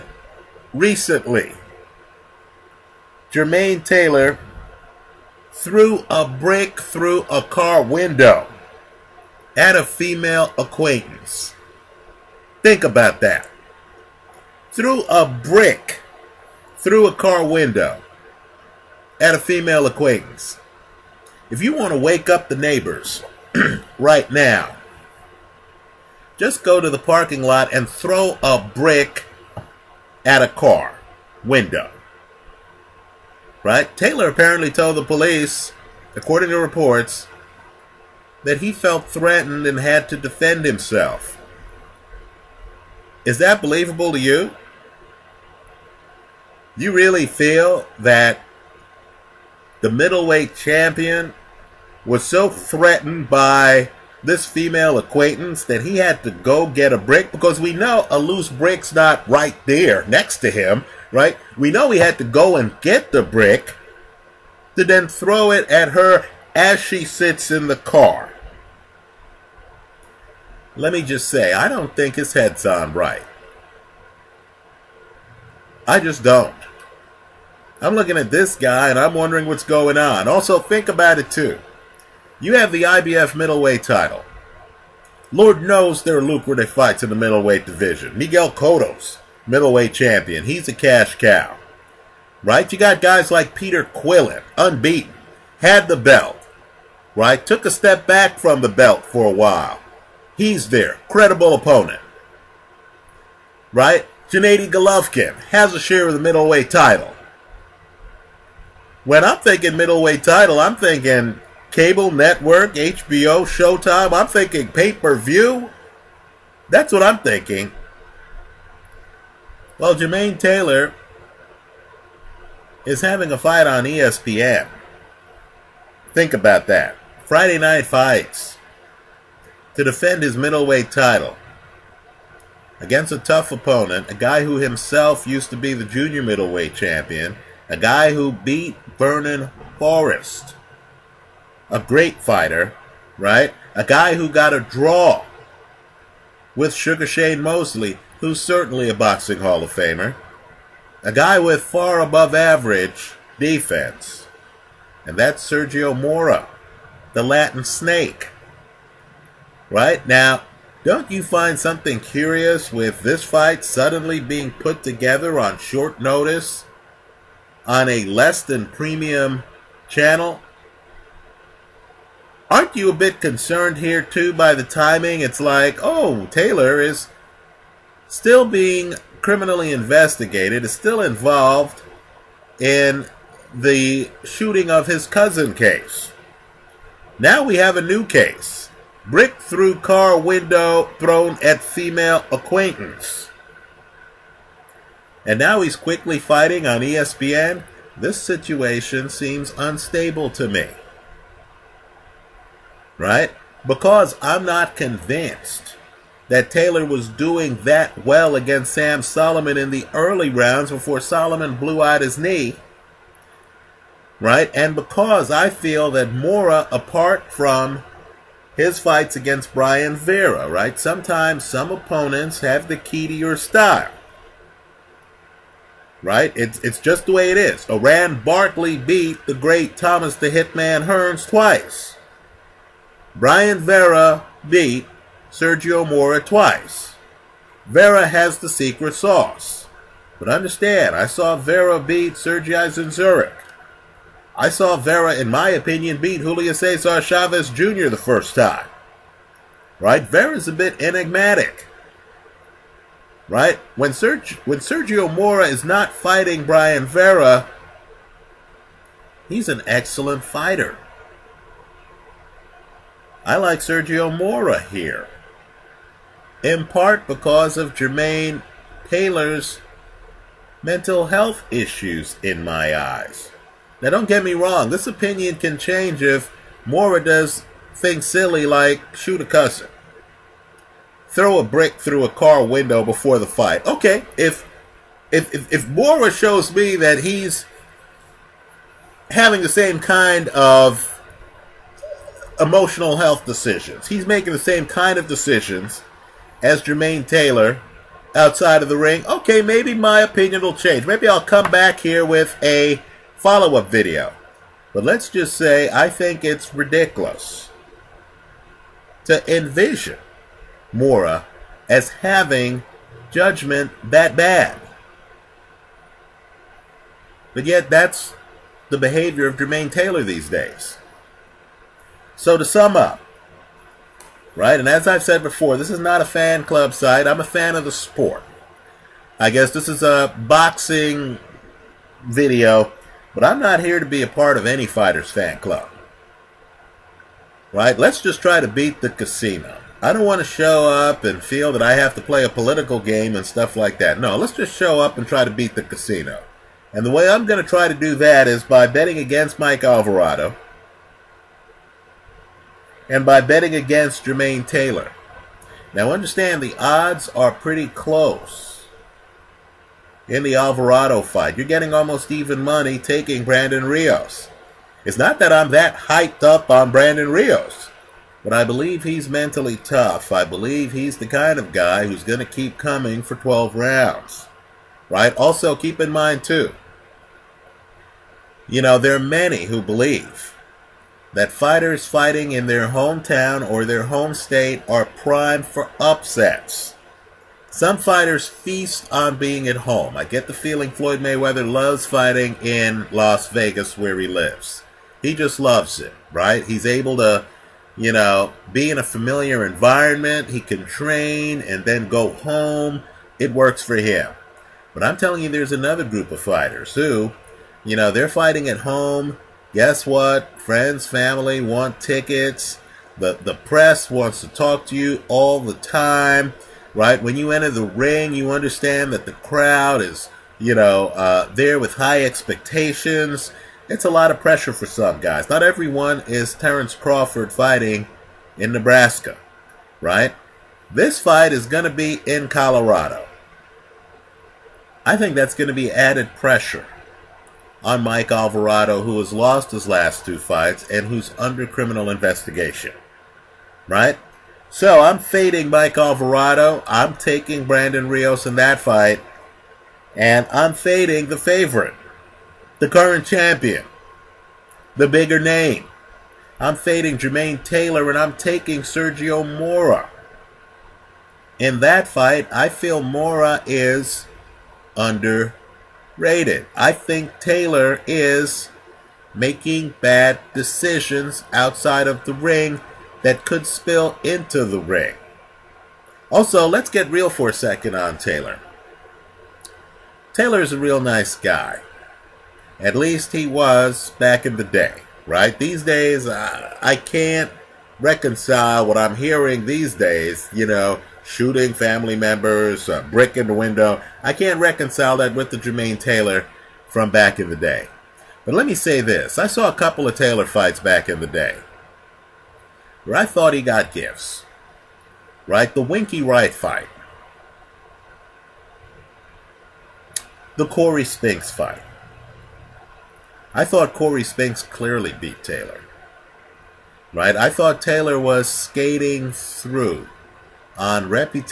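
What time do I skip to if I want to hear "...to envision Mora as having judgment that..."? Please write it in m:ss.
5:09.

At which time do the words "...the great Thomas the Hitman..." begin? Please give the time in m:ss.
3:49.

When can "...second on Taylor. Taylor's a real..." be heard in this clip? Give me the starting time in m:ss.
7:57.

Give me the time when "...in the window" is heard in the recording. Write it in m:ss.
8:13.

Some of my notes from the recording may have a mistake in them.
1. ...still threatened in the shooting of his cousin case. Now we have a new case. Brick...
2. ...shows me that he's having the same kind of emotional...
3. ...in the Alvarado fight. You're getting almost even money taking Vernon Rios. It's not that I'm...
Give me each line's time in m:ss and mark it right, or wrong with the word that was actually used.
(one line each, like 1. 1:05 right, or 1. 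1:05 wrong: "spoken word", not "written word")
1. 3:00 wrong: "involved", not "threatened"
2. 4:46 right
3. 6:00 wrong: "Brandon", not "Vernon".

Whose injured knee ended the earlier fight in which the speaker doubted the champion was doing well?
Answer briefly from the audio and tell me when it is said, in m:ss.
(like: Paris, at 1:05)
Sam Soliman, at 3:28.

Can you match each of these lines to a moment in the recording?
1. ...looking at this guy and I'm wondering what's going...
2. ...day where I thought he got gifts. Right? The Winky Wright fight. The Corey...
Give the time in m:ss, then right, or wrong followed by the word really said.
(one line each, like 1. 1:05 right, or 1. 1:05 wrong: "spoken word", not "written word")
1. 1:17 right
2. 8:21 right.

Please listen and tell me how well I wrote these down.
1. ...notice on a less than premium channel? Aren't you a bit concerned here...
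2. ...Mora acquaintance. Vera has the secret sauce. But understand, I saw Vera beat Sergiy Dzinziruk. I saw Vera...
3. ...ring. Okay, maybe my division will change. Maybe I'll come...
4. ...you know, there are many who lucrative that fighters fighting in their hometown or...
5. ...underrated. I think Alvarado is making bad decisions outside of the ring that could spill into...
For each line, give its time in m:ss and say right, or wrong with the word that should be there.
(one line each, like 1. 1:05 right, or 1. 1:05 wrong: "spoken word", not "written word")
1. 2:45 right
2. 3:55 wrong: "twice", not "acquaintance"
3. 4:58 wrong: "opinion", not "division"
4. 6:18 wrong: "believe", not "lucrative"
5. 7:44 wrong: "Taylor", not "Alvarado".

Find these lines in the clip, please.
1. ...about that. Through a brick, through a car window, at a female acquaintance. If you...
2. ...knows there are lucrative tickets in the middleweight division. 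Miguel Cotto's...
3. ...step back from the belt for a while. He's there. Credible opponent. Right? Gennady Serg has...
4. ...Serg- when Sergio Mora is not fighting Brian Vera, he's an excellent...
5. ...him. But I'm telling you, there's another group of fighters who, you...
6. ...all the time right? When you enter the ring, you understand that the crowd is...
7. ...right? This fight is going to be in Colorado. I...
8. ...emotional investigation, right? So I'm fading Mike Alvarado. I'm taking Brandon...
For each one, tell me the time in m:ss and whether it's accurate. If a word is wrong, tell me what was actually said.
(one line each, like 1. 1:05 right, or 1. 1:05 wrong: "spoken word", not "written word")
1. 0:12 right
2. 1:25 wrong: "fights", not "tickets"
3. 1:37 wrong: "Golovkin", not "Serg"
4. 4:13 right
5. 6:43 right
6. 6:55 right
7. 7:09 right
8. 7:21 wrong: "criminal", not "emotional".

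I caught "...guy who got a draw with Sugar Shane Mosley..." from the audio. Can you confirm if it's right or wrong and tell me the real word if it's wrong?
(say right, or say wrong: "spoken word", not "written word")
right.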